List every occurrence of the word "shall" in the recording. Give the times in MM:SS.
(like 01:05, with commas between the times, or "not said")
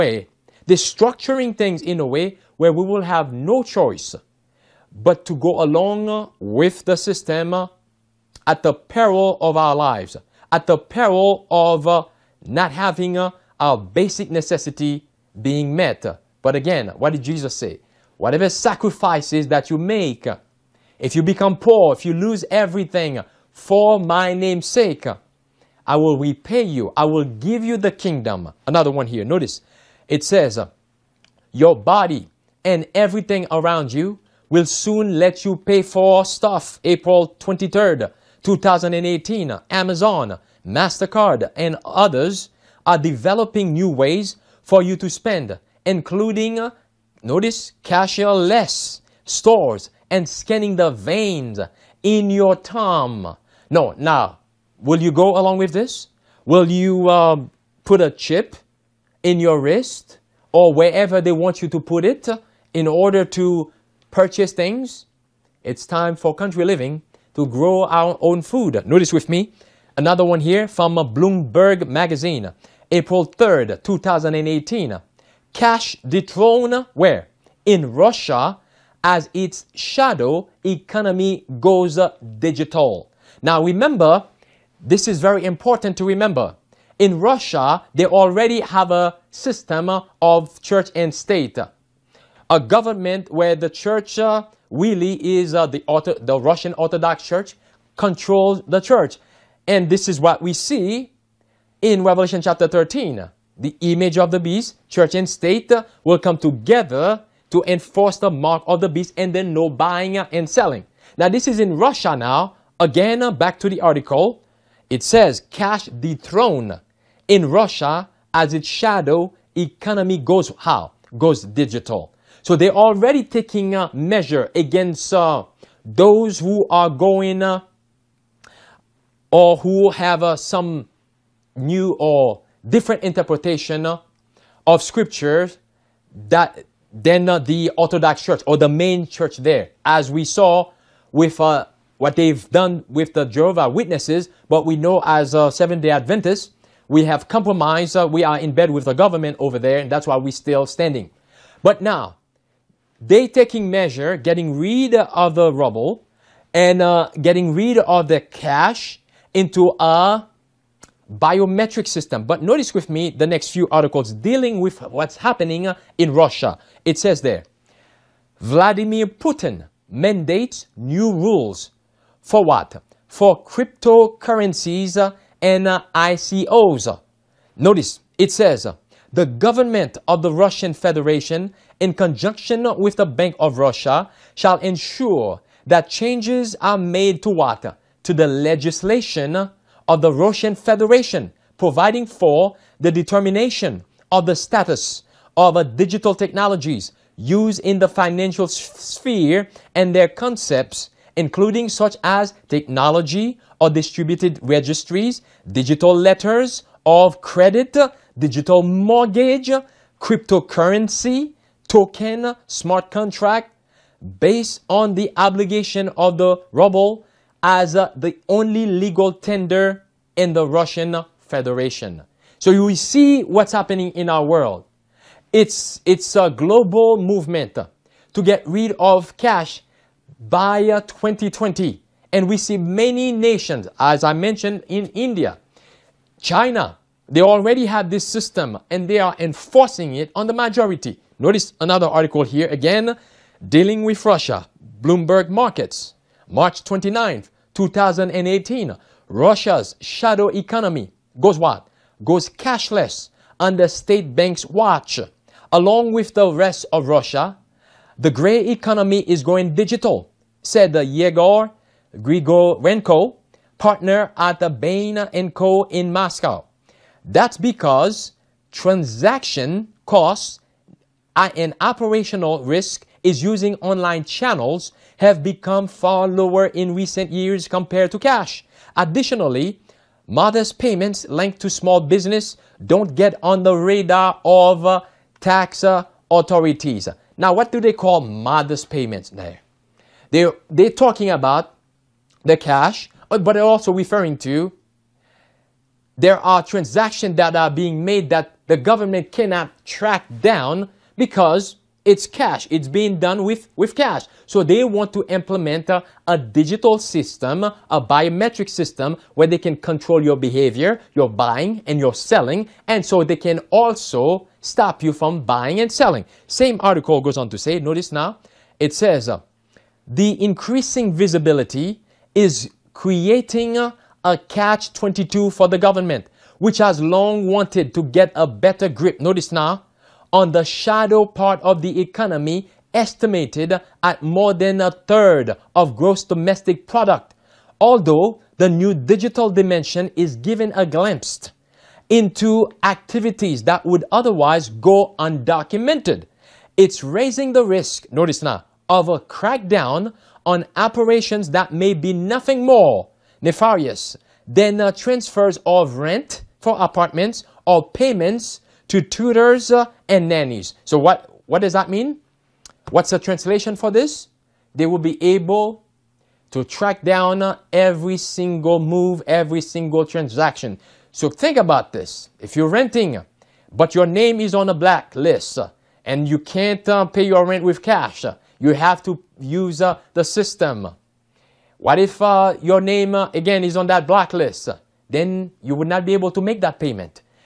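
03:04.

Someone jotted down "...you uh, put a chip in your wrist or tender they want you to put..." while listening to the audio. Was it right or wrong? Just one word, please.
wrong.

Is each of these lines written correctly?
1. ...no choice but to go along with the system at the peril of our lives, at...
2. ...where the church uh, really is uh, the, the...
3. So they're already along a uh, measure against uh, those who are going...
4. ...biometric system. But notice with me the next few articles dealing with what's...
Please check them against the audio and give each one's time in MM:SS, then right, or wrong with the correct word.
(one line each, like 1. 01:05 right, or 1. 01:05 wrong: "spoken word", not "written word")
1. 00:03 right
2. 01:33 right
3. 02:02 wrong: "taking", not "along"
4. 02:41 right.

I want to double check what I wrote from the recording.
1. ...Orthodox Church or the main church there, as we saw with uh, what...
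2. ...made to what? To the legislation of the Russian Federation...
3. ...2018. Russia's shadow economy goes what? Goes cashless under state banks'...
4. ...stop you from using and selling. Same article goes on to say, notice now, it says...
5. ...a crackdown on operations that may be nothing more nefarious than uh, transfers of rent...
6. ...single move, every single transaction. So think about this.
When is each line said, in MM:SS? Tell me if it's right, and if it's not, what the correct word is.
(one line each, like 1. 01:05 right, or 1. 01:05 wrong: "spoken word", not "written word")
1. 02:17 right
2. 03:06 right
3. 04:07 right
4. 05:14 wrong: "buying", not "using"
5. 05:48 right
6. 06:07 right.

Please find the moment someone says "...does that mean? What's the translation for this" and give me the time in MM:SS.
06:01.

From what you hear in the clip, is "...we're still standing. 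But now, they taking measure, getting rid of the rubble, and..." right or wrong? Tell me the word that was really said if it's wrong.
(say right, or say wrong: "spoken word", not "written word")
right.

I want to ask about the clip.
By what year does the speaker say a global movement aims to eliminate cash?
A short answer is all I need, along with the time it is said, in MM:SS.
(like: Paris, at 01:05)
2020, at 03:50.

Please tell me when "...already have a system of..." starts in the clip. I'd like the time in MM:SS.
01:28.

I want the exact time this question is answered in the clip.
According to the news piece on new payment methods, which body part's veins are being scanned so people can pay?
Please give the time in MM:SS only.
00:52.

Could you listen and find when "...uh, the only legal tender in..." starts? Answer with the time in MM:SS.
03:37.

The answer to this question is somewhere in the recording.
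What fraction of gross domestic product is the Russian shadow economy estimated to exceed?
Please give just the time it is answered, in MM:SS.
05:34.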